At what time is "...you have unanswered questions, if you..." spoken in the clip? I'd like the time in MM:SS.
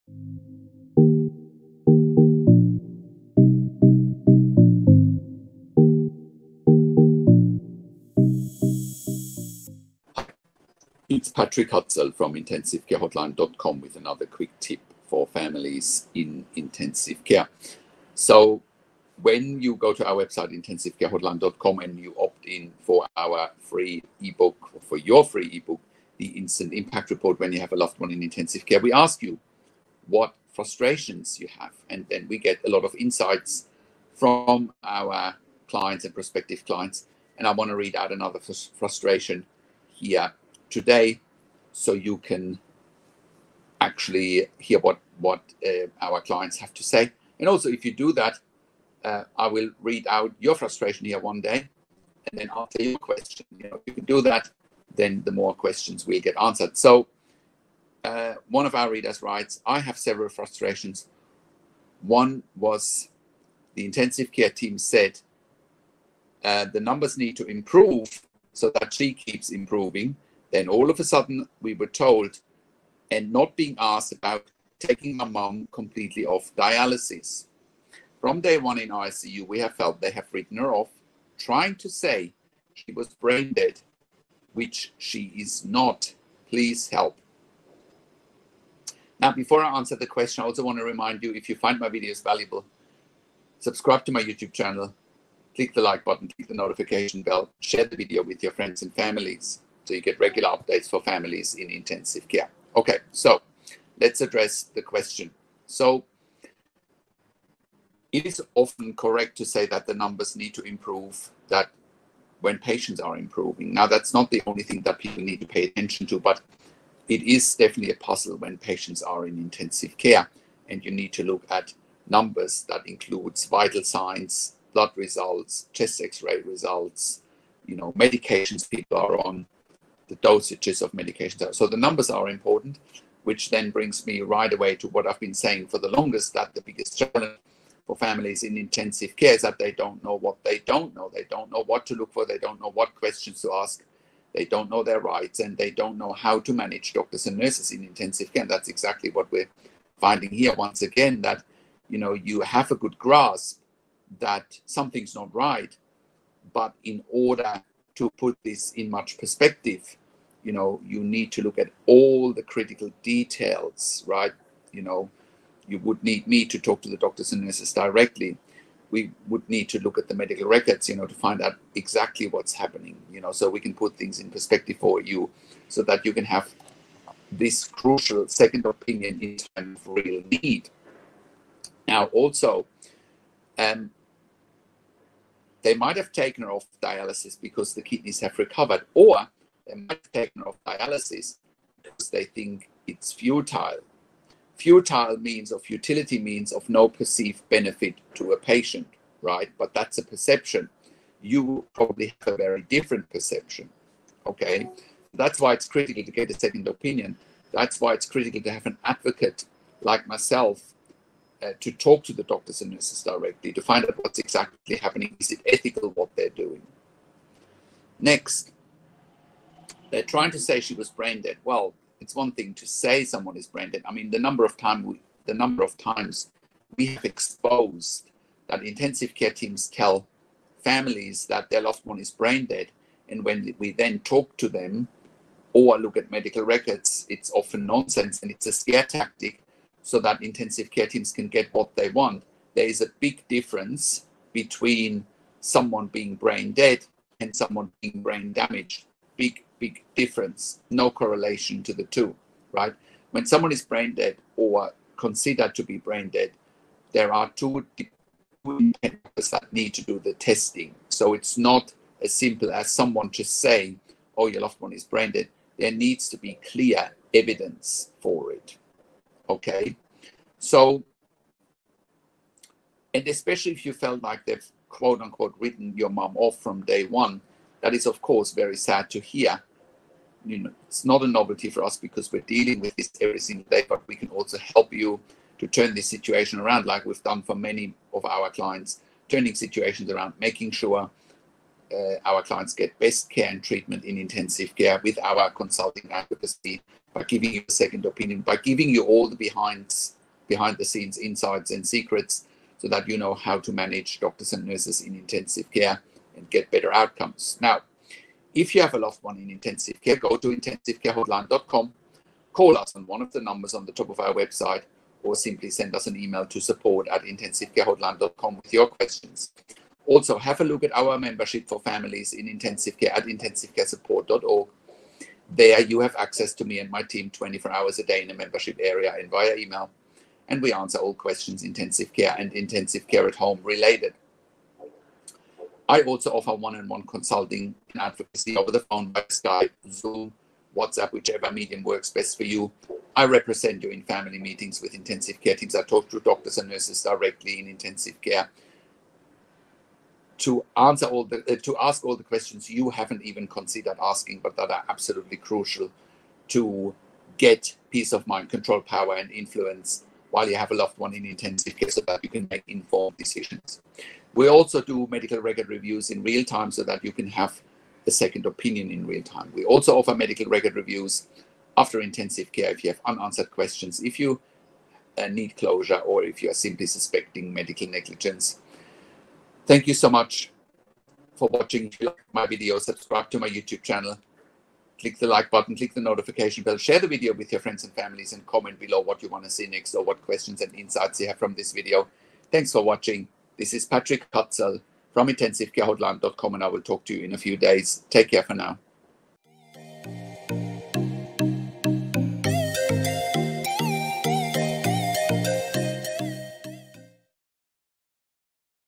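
06:12.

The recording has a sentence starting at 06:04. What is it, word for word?
We also do medical record reviews in real time so that you can have a second opinion in real time.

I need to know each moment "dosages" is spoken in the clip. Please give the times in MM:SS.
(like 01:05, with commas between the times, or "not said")
02:10.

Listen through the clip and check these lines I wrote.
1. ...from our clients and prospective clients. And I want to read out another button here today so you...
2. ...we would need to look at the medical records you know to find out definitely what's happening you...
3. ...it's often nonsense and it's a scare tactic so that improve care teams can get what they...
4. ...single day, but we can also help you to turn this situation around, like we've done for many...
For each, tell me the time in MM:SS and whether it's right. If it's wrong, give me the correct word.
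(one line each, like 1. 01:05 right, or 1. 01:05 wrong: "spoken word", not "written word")
1. 00:34 wrong: "frustration", not "button"
2. 02:48 wrong: "exactly", not "definitely"
3. 03:57 wrong: "intensive", not "improve"
4. 04:43 right.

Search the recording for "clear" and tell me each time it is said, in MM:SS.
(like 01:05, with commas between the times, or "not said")
04:26.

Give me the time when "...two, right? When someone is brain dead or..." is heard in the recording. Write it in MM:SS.
04:11.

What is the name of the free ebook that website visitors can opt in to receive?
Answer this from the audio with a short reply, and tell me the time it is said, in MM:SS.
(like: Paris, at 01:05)
Instant Impact Report, at 00:26.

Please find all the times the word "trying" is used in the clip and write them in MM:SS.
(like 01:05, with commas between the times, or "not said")
01:21, 03:40.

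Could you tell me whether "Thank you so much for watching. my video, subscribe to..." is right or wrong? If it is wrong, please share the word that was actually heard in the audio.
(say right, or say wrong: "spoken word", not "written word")
right.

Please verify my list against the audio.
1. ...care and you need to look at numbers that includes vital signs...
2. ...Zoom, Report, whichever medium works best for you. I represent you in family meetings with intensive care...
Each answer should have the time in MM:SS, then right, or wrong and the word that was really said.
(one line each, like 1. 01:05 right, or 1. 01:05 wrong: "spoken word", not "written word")
1. 01:59 right
2. 05:39 wrong: "WhatsApp", not "Report".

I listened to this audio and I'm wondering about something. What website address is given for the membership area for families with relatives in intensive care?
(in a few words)
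intensivecaresupport.org.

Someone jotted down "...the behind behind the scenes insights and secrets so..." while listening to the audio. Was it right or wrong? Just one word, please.
right.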